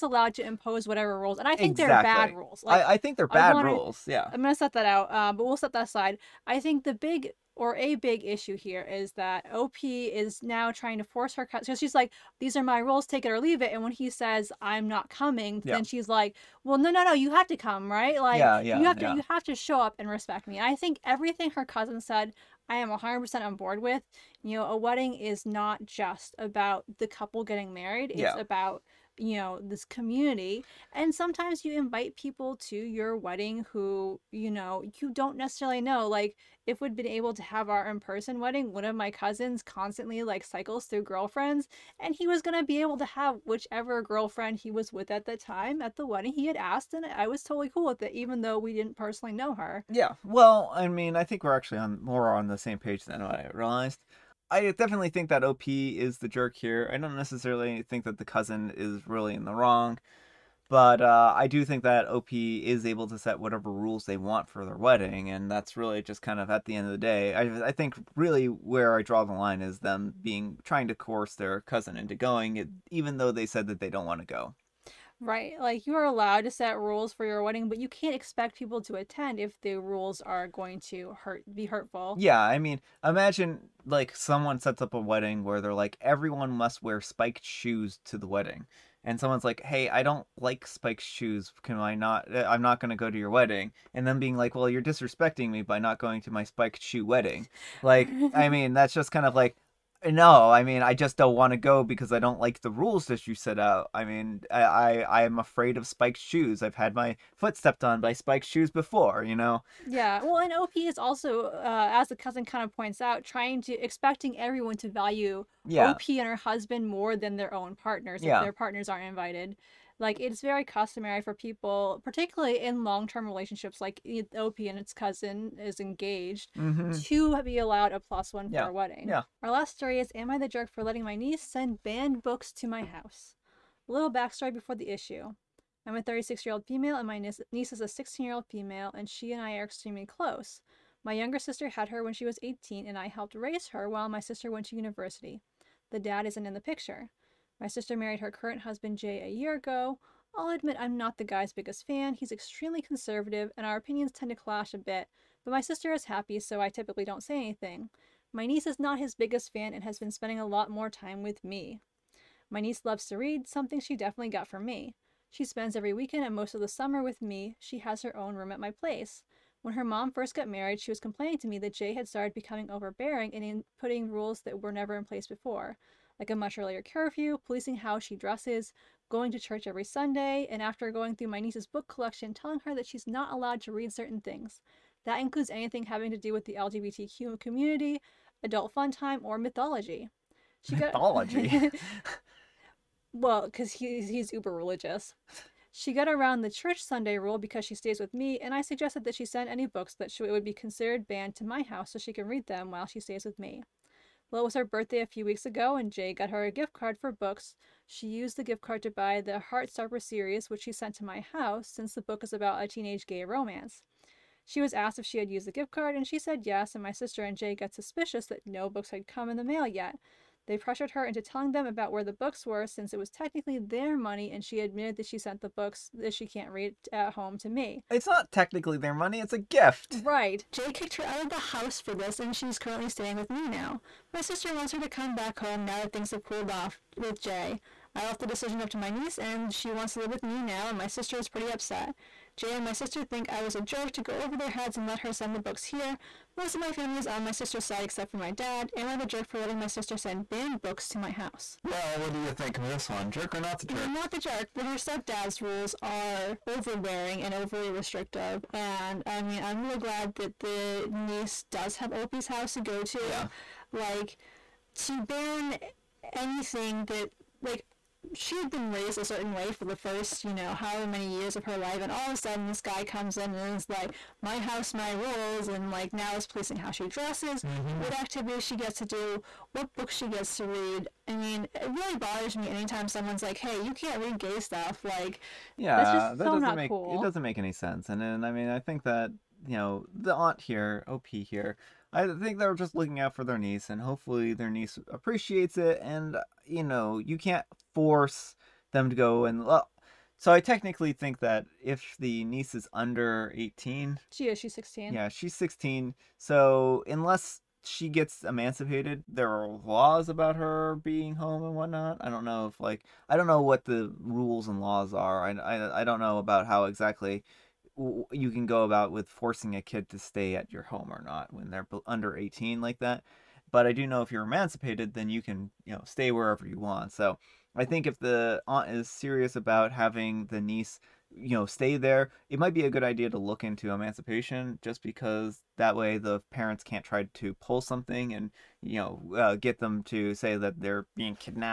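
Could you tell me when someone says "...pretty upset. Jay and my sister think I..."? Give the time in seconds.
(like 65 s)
241 s.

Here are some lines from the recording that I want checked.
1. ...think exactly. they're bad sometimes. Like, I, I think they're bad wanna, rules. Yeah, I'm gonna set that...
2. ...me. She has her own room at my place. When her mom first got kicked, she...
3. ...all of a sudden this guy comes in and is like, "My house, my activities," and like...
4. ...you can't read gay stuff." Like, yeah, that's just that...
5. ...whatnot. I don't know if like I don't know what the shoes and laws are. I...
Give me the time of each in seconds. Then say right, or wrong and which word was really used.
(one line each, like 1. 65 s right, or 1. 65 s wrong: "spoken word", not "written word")
1. 1 s wrong: "rules", not "sometimes"
2. 167 s wrong: "married", not "kicked"
3. 271 s wrong: "rules", not "activities"
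4. 283 s right
5. 311 s wrong: "rules", not "shoes".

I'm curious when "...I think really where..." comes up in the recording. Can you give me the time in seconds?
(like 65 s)
67 s.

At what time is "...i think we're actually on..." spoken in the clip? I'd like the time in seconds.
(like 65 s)
51 s.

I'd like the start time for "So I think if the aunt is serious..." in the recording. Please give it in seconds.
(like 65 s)
326 s.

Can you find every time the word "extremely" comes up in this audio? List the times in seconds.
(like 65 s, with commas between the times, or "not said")
139 s, 152 s.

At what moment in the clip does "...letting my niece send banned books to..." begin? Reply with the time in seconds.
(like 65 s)
130 s.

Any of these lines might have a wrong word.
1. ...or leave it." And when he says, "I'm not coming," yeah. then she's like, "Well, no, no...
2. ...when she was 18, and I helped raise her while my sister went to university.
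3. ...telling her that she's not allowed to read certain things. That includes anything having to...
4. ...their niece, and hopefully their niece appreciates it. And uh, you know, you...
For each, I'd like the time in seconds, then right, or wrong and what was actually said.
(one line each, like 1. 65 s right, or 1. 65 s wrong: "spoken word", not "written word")
1. 13 s right
2. 142 s right
3. 182 s right
4. 293 s right.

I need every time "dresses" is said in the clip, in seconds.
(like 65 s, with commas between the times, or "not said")
178 s, 276 s.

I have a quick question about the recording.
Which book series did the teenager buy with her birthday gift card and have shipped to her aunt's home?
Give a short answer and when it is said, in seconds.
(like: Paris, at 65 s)
Heartstopper, at 209 s.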